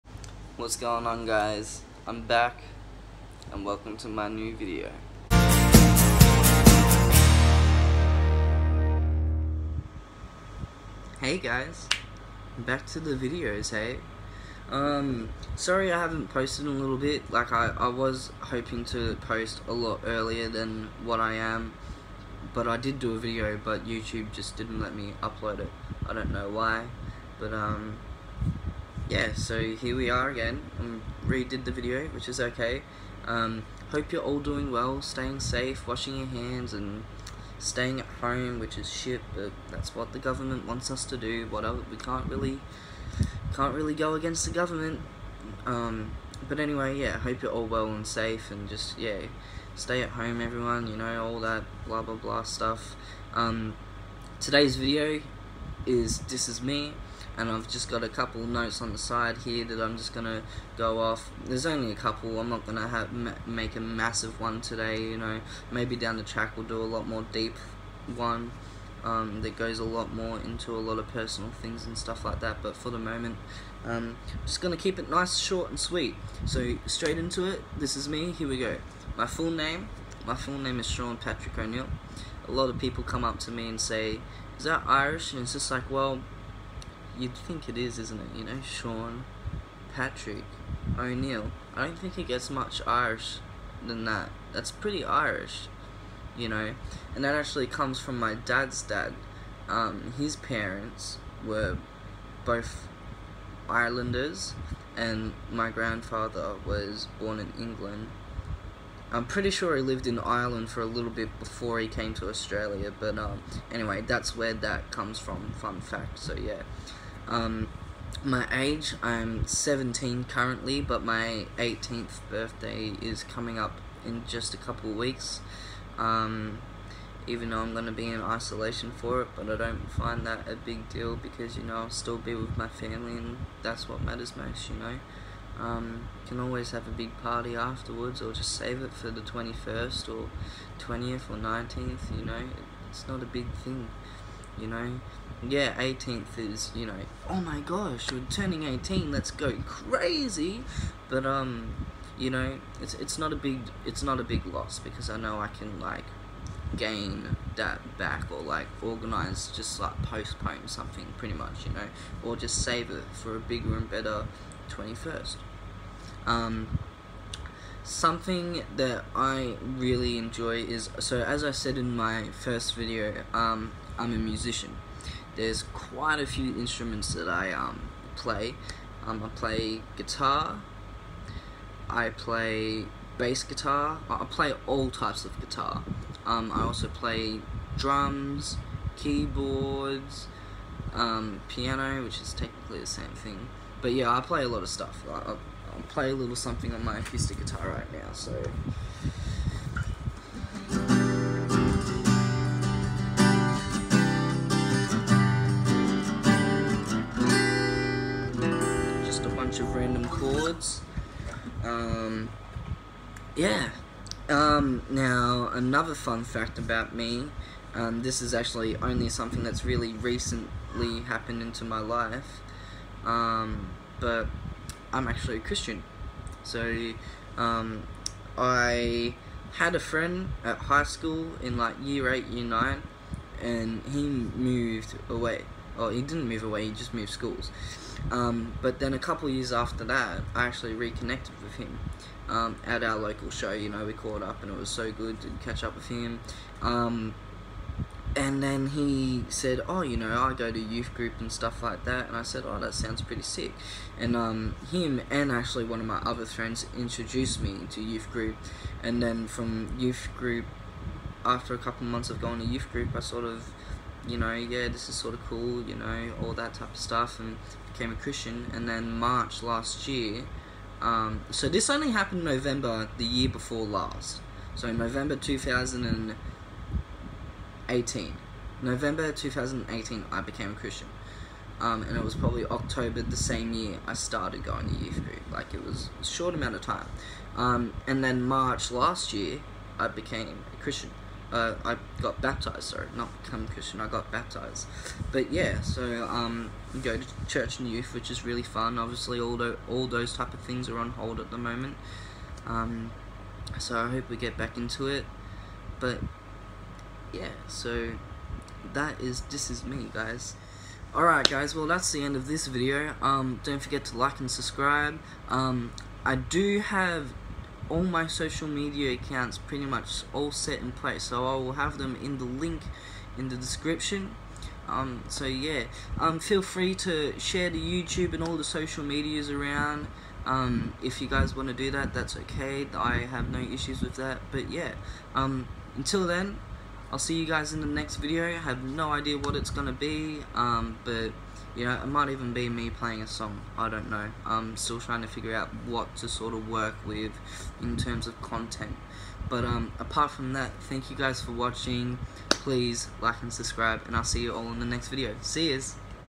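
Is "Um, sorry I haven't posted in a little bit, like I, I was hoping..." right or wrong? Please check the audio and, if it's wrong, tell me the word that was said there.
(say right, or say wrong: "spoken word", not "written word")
right.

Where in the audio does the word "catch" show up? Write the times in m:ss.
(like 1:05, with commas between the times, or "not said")
4:05.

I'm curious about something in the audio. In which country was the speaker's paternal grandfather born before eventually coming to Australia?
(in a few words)
England.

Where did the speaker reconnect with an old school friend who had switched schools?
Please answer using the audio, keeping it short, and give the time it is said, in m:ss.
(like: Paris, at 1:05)
local show, at 4:02.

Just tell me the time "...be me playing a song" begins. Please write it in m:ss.
5:42.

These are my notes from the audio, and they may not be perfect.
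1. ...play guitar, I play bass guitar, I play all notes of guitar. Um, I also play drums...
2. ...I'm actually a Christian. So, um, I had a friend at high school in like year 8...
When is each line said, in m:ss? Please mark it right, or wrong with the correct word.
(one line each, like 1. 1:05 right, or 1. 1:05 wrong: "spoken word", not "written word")
1. 2:59 wrong: "types", not "notes"
2. 3:44 right.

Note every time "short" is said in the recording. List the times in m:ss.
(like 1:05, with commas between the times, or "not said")
1:15, 4:46.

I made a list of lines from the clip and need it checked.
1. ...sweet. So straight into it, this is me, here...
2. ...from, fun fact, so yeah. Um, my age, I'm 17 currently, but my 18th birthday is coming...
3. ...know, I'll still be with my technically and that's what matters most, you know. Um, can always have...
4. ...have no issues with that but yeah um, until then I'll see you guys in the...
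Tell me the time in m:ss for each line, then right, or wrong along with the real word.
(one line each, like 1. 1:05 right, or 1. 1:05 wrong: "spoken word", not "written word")
1. 1:15 right
2. 1:55 right
3. 2:11 wrong: "family", not "technically"
4. 5:33 right.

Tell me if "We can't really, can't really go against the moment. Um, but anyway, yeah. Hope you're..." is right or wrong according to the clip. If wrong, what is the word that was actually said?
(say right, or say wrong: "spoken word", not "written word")
wrong: "government", not "moment".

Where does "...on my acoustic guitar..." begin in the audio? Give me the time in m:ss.
3:16.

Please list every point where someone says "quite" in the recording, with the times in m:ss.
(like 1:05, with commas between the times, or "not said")
2:55.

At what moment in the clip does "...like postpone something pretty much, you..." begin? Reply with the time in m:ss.
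2:39.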